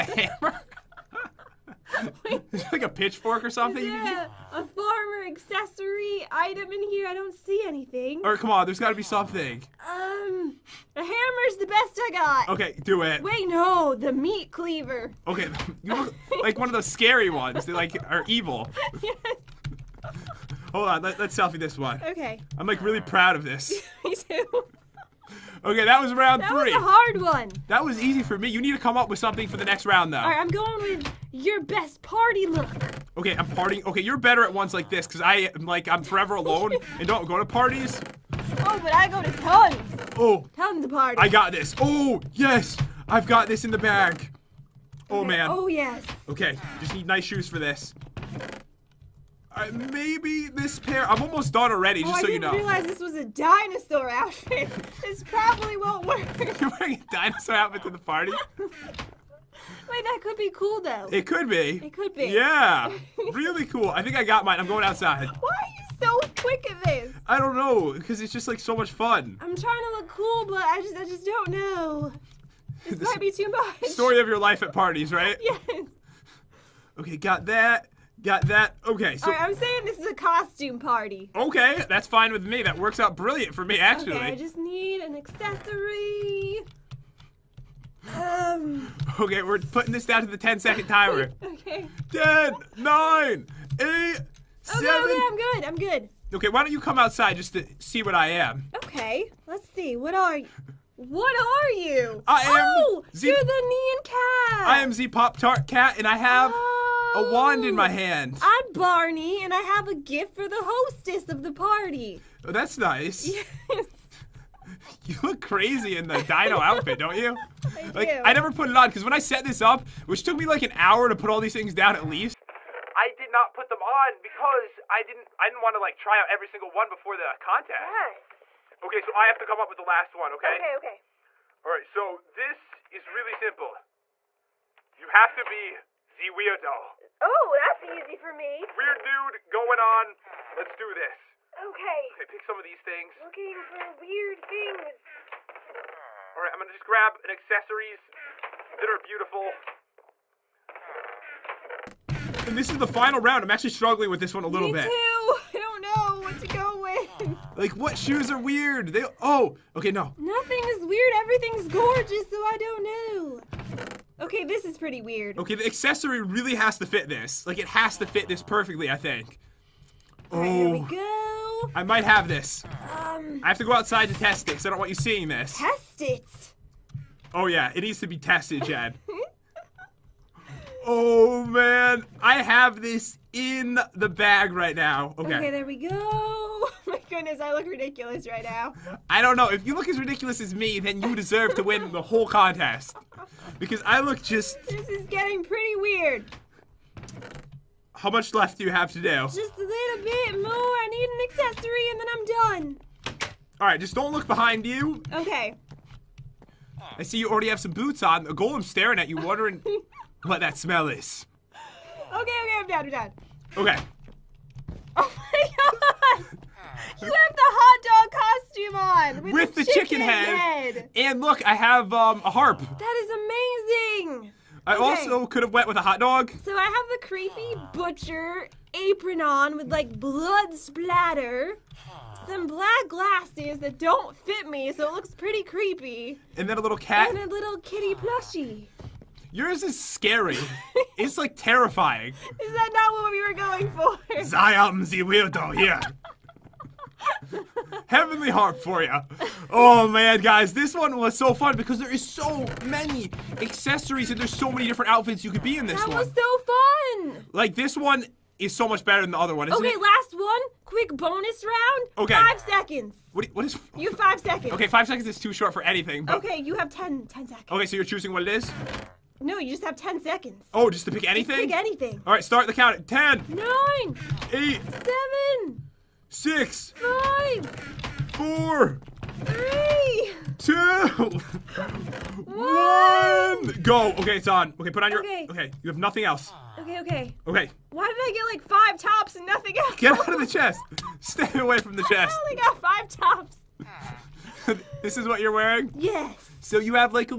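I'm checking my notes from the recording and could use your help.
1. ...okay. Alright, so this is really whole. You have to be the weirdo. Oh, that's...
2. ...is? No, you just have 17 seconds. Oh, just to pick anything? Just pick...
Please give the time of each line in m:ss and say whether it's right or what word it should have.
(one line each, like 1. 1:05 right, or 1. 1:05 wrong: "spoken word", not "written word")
1. 2:10 wrong: "simple", not "whole"
2. 4:28 wrong: "10", not "17".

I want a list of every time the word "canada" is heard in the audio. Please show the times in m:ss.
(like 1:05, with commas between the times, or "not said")
not said.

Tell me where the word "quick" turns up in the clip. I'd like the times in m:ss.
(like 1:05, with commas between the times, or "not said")
1:06, 4:20.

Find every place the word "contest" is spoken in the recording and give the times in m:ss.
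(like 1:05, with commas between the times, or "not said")
2:07, 3:12.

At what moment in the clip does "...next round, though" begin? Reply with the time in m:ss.
0:29.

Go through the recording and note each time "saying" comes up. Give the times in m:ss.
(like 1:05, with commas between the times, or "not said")
1:19.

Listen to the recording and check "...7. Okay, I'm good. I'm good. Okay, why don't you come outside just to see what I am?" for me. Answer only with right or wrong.
right.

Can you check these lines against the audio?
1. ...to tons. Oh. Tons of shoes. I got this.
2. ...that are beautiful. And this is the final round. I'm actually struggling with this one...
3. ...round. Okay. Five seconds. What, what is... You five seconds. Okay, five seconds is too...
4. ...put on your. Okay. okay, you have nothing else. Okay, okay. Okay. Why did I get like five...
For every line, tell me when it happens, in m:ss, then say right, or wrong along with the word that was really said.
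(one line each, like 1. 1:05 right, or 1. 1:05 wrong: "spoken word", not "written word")
1. 0:39 wrong: "parties", not "shoes"
2. 2:28 right
3. 4:21 right
4. 4:44 right.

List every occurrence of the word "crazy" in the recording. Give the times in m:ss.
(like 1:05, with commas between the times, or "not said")
1:55.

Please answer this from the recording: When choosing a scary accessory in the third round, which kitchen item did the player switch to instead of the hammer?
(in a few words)
meat cleaver.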